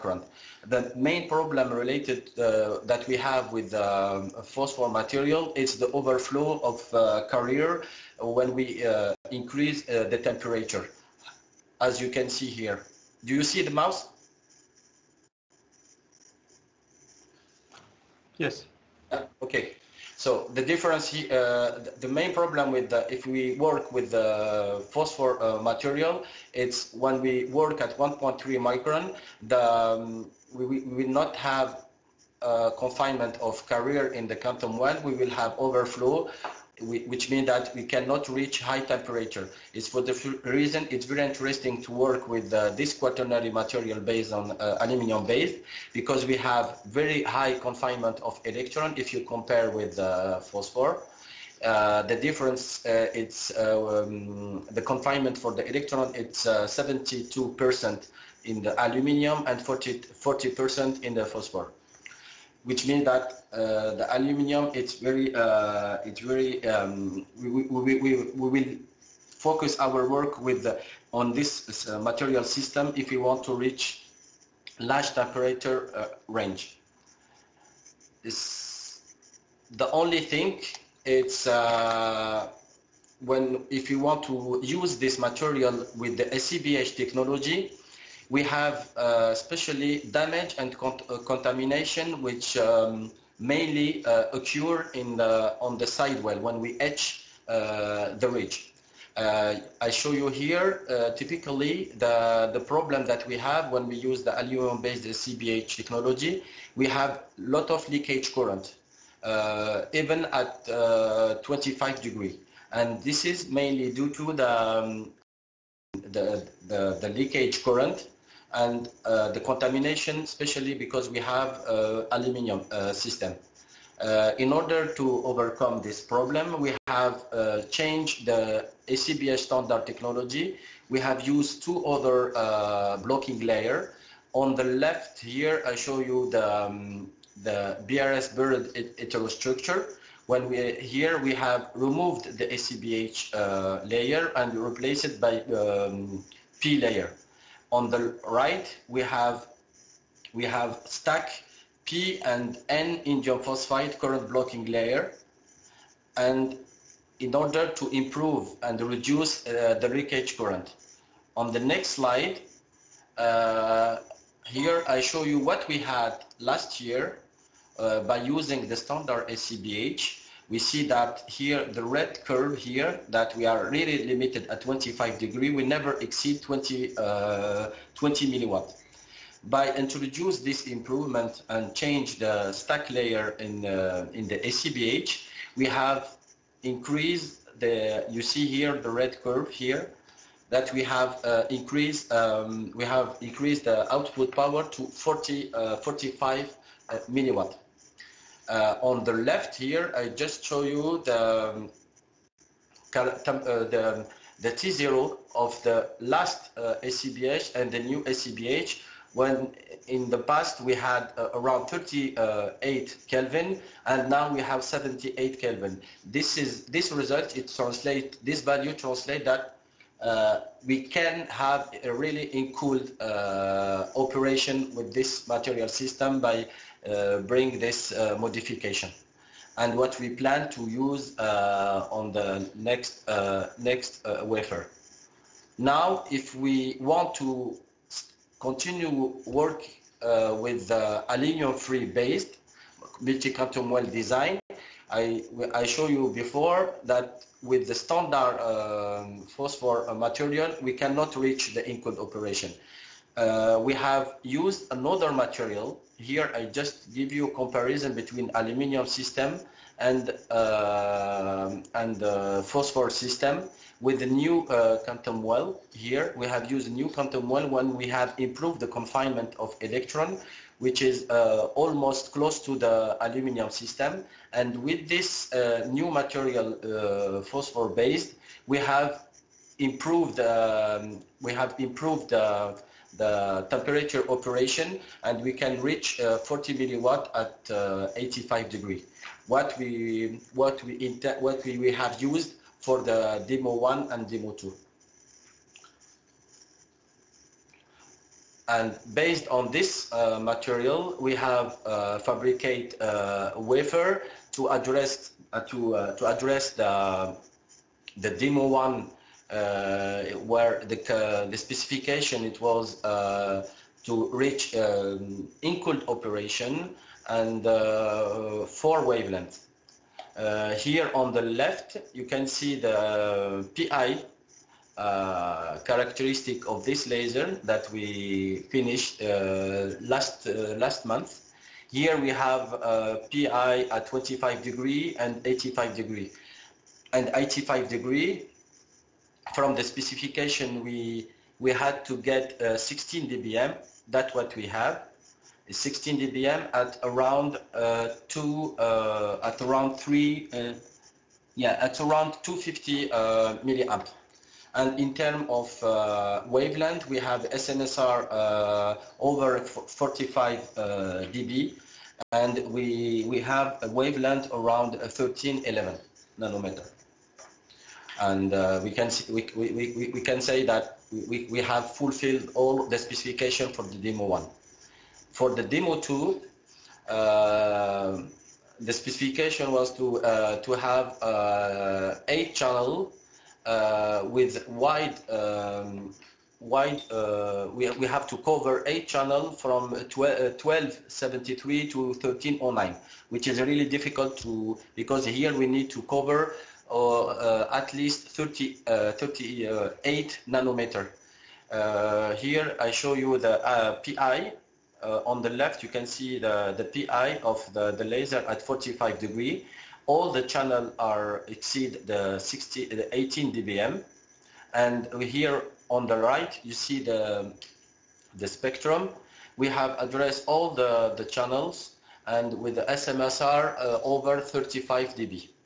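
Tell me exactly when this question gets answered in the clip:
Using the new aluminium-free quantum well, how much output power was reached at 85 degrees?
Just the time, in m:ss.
4:46.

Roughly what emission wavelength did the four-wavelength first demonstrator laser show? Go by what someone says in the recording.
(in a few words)
1311 nanometers.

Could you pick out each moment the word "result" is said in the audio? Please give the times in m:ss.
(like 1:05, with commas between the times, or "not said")
3:36.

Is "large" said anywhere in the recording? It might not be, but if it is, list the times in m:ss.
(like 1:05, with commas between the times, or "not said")
1:14.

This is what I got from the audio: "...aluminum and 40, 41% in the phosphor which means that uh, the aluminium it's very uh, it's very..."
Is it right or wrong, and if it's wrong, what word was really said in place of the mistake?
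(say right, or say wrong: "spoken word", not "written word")
wrong: "40", not "41".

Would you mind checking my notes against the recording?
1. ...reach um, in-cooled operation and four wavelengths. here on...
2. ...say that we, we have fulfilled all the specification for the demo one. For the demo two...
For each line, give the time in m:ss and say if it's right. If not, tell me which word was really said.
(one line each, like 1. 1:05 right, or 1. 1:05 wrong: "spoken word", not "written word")
1. 5:14 right
2. 6:10 right.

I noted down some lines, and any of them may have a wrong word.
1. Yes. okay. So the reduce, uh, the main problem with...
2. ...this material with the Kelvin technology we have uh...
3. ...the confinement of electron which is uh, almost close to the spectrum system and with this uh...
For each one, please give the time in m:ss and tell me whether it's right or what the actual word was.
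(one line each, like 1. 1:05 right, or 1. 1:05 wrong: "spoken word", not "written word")
1. 0:18 wrong: "difference", not "reduce"
2. 1:24 wrong: "SCBH", not "Kelvin"
3. 4:28 wrong: "aluminium", not "spectrum".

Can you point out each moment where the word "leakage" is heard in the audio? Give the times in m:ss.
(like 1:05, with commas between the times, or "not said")
1:47, 1:57, 2:39.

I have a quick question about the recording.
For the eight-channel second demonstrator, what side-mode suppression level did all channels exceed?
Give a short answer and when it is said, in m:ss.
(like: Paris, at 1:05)
35 dB, at 7:04.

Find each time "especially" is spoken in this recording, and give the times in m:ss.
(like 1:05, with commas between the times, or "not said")
1:29, 2:00.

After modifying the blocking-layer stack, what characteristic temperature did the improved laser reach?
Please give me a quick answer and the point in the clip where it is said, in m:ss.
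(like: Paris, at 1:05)
78 Kelvin, at 3:34.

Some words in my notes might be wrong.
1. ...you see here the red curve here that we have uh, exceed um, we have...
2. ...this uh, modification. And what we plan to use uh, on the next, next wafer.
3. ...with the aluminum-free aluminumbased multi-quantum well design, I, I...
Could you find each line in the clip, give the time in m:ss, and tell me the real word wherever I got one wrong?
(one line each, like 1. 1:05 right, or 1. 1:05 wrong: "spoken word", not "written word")
1. 3:08 wrong: "increased", not "exceed"
2. 3:47 right
3. 4:00 wrong: "based", not "aluminumbased".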